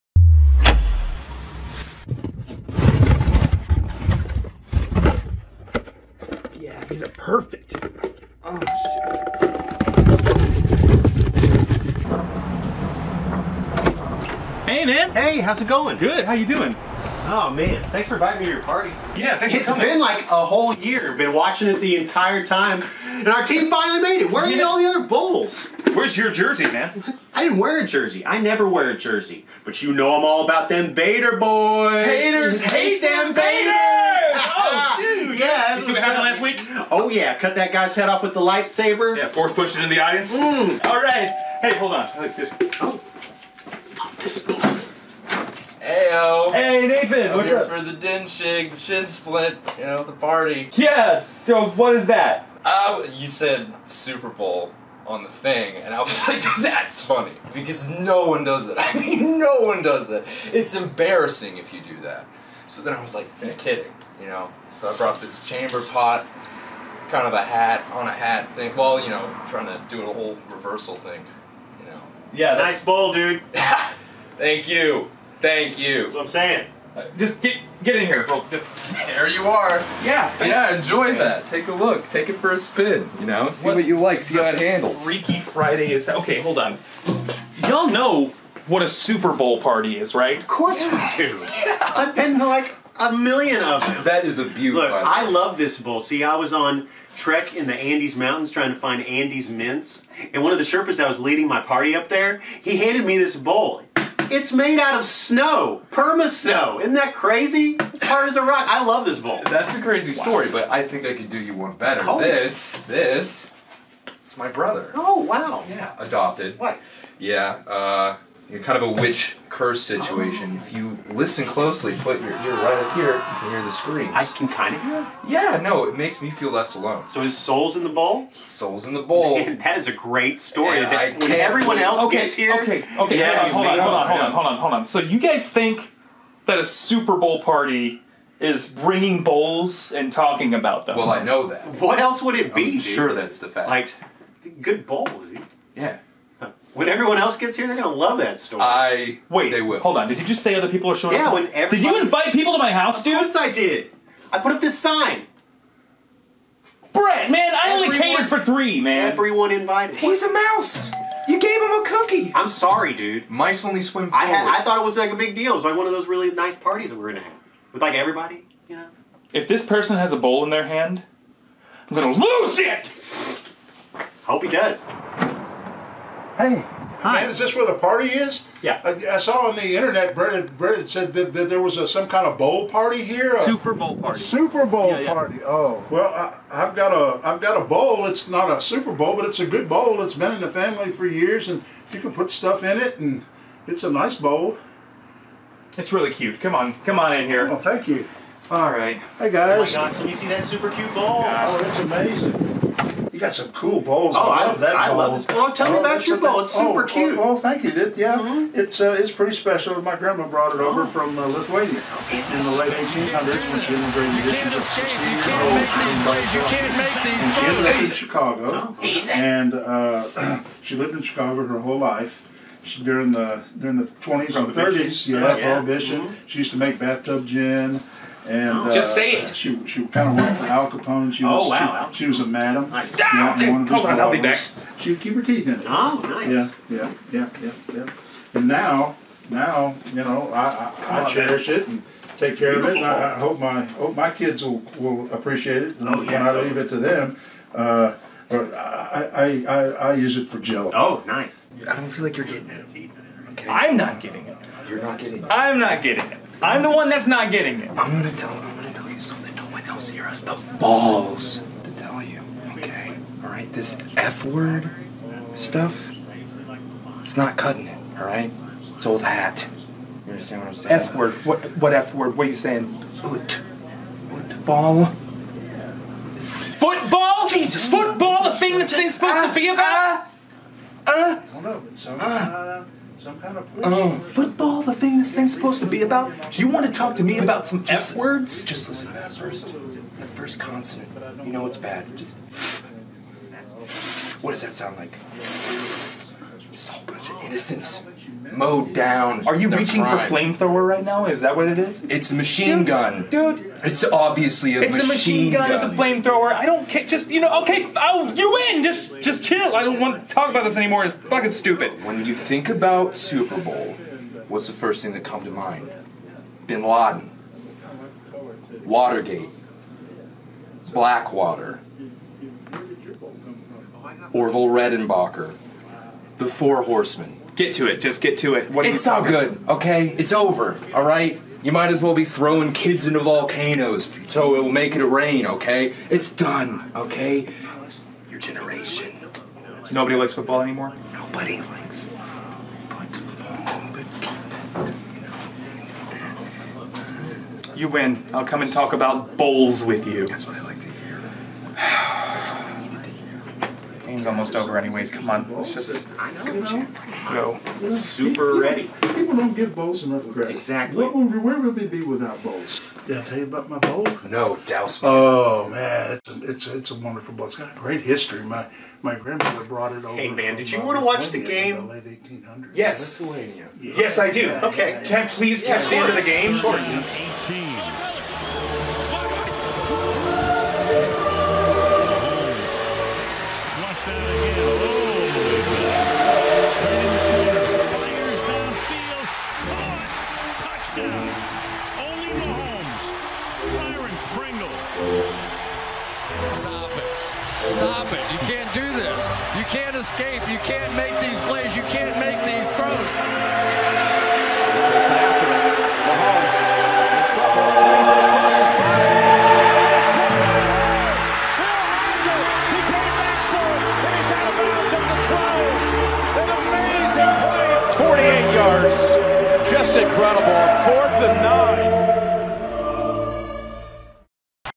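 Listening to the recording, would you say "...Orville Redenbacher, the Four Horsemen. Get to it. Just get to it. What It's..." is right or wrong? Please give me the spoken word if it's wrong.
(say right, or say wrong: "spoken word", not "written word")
right.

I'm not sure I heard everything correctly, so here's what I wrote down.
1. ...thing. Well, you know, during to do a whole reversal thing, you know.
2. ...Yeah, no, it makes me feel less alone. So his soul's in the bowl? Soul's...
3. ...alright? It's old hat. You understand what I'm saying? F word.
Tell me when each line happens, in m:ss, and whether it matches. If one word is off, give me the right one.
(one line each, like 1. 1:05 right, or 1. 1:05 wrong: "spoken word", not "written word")
1. 1:08 wrong: "trying", not "during"
2. 2:05 right
3. 4:27 right.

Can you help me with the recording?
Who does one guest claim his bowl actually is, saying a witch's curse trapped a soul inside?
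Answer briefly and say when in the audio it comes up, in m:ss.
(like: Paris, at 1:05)
my brother, at 1:54.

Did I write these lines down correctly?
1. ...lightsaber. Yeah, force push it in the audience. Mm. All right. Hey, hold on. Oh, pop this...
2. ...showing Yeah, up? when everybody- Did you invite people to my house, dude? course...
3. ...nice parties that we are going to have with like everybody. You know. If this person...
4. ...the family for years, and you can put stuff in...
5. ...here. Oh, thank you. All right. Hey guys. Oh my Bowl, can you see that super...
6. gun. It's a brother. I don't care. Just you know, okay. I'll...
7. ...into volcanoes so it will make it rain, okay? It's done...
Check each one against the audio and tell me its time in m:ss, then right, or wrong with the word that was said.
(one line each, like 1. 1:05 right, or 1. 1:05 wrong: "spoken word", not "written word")
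1. 0:38 right
2. 2:30 right
3. 2:46 right
4. 3:10 right
5. 3:17 wrong: "God", not "Bowl"
6. 5:05 wrong: "flamethrower", not "brother"
7. 5:32 right.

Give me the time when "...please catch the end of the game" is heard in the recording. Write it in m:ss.
6:15.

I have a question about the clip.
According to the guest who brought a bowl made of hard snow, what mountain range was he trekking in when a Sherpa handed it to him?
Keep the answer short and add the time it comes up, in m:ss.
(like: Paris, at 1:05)
Andes Mountains, at 1:37.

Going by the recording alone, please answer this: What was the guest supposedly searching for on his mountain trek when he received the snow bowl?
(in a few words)
Andes mints.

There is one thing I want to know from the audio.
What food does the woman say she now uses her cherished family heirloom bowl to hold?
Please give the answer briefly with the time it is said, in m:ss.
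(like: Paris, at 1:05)
jello, at 4:10.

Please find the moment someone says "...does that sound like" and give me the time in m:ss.
4:54.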